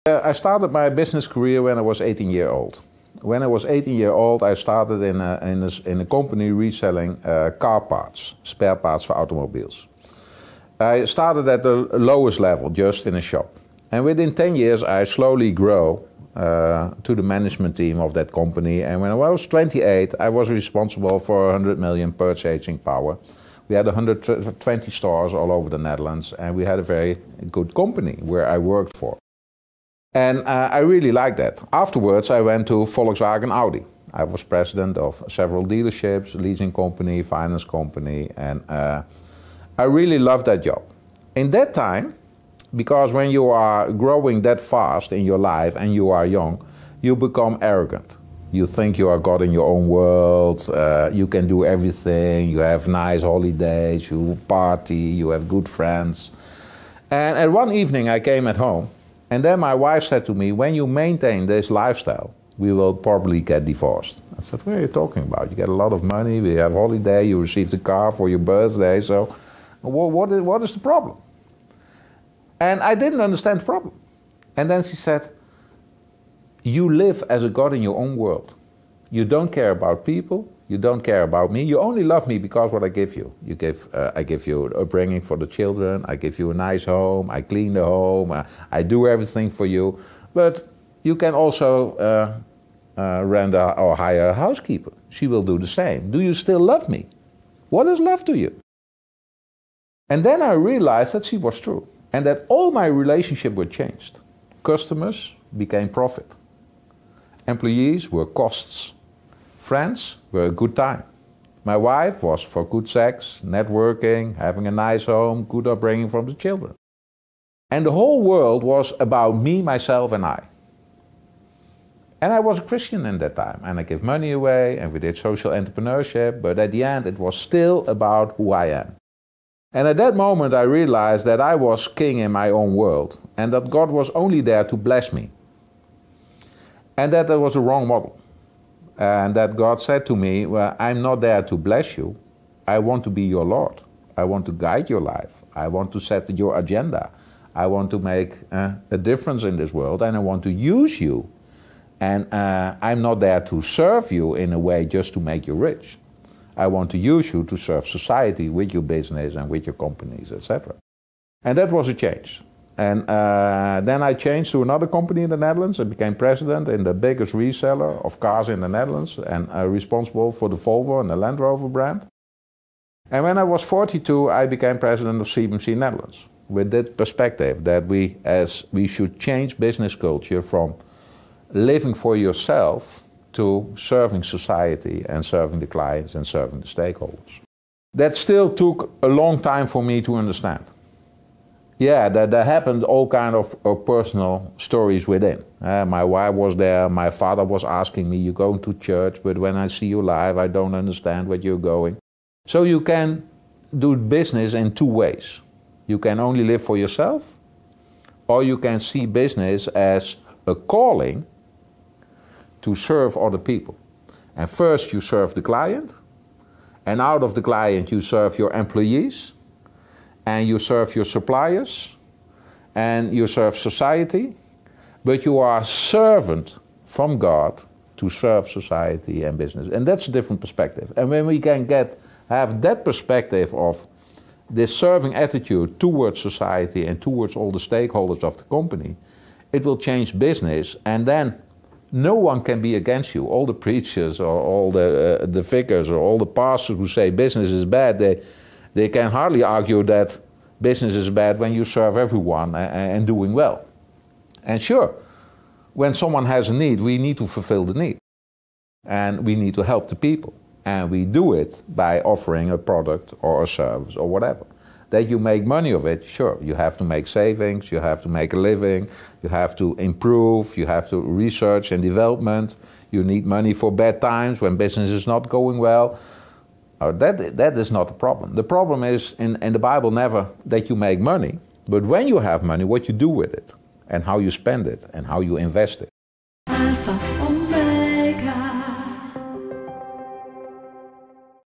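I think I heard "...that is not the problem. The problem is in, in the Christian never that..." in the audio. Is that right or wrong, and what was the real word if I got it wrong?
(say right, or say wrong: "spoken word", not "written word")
wrong: "Bible", not "Christian".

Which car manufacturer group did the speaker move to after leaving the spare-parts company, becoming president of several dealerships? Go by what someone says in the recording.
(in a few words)
Volkswagen Audi.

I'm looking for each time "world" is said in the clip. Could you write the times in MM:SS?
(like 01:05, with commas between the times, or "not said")
00:49, 01:18, 01:58, 02:12, 02:29.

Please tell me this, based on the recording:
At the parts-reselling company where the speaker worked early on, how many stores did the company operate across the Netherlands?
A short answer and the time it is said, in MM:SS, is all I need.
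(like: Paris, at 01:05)
120, at 00:23.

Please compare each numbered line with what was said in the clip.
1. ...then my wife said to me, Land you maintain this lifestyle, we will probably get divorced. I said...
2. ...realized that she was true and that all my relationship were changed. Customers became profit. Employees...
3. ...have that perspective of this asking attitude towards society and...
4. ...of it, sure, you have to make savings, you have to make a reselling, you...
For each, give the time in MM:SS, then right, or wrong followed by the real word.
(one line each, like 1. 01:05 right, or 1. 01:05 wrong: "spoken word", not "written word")
1. 00:59 wrong: "When", not "Land"
2. 01:40 right
3. 03:52 wrong: "serving", not "asking"
4. 04:25 wrong: "living", not "reselling".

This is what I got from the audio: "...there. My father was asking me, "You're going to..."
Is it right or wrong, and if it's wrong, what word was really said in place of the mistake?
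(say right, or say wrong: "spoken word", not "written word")
right.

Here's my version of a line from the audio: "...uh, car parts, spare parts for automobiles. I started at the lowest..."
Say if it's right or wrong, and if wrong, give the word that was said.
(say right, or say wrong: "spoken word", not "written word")
right.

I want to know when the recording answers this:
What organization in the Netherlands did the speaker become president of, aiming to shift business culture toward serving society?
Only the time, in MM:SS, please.
02:55.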